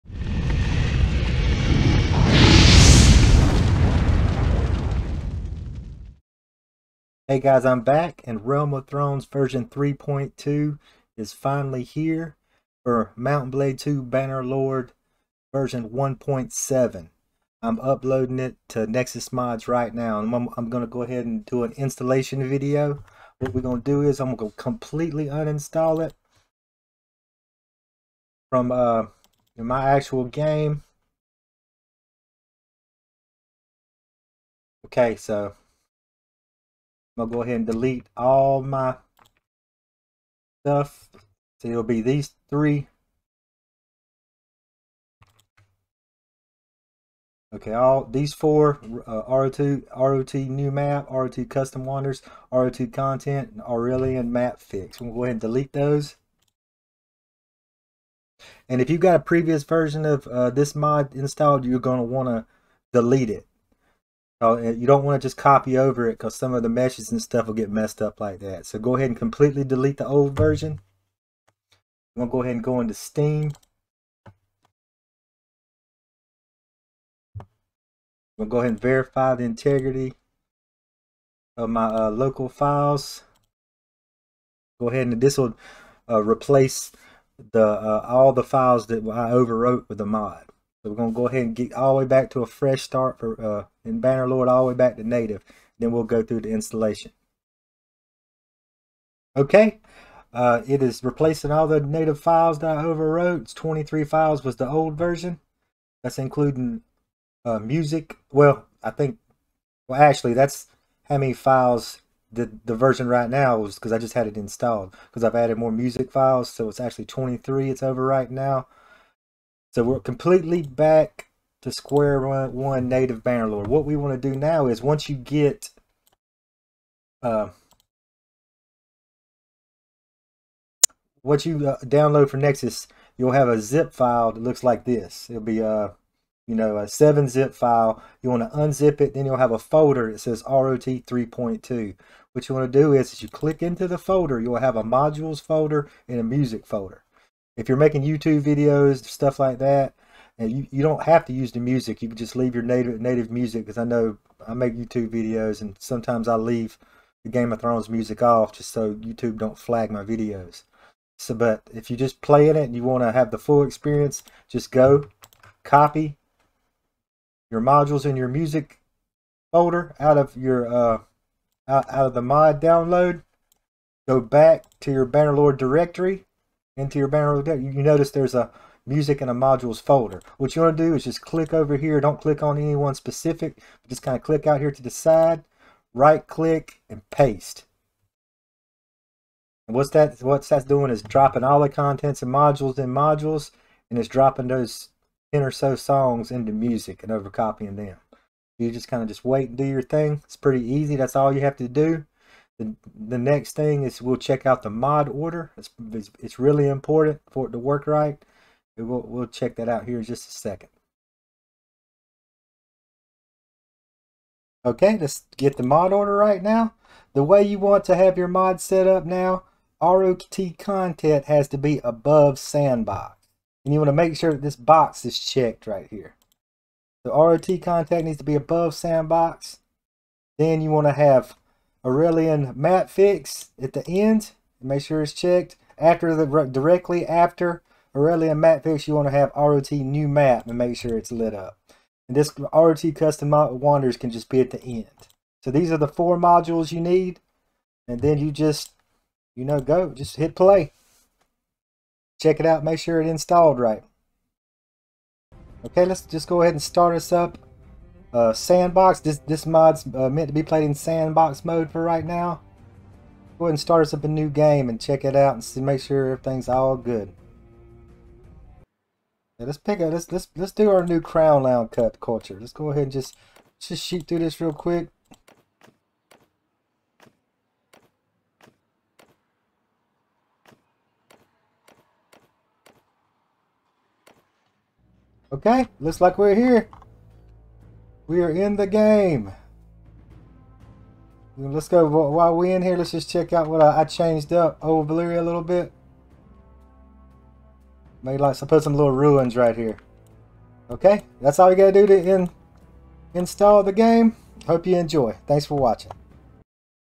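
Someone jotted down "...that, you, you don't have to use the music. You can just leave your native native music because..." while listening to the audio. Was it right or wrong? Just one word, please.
right.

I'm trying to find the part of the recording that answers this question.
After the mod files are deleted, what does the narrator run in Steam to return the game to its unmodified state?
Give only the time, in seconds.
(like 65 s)
78 s.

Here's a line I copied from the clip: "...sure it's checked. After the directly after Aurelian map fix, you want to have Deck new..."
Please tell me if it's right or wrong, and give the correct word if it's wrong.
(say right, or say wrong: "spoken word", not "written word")
wrong: "ROT", not "Deck".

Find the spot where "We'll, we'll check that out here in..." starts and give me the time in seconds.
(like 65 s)
208 s.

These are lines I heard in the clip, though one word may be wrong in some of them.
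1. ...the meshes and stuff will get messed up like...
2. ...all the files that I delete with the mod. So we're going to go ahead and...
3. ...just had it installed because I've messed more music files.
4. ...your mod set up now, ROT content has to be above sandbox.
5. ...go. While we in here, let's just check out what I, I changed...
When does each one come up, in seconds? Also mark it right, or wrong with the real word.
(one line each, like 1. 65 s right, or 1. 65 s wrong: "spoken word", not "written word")
1. 66 s right
2. 88 s wrong: "overwrote", not "delete"
3. 113 s wrong: "added", not "messed"
4. 218 s right
5. 291 s right.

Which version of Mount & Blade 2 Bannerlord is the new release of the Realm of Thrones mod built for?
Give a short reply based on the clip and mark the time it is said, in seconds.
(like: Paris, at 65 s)
1.7, at 15 s.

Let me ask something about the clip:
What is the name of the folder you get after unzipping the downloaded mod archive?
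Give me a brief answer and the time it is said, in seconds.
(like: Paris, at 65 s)
ROT 3.2, at 140 s.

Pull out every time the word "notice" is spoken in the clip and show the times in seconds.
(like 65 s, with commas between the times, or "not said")
177 s.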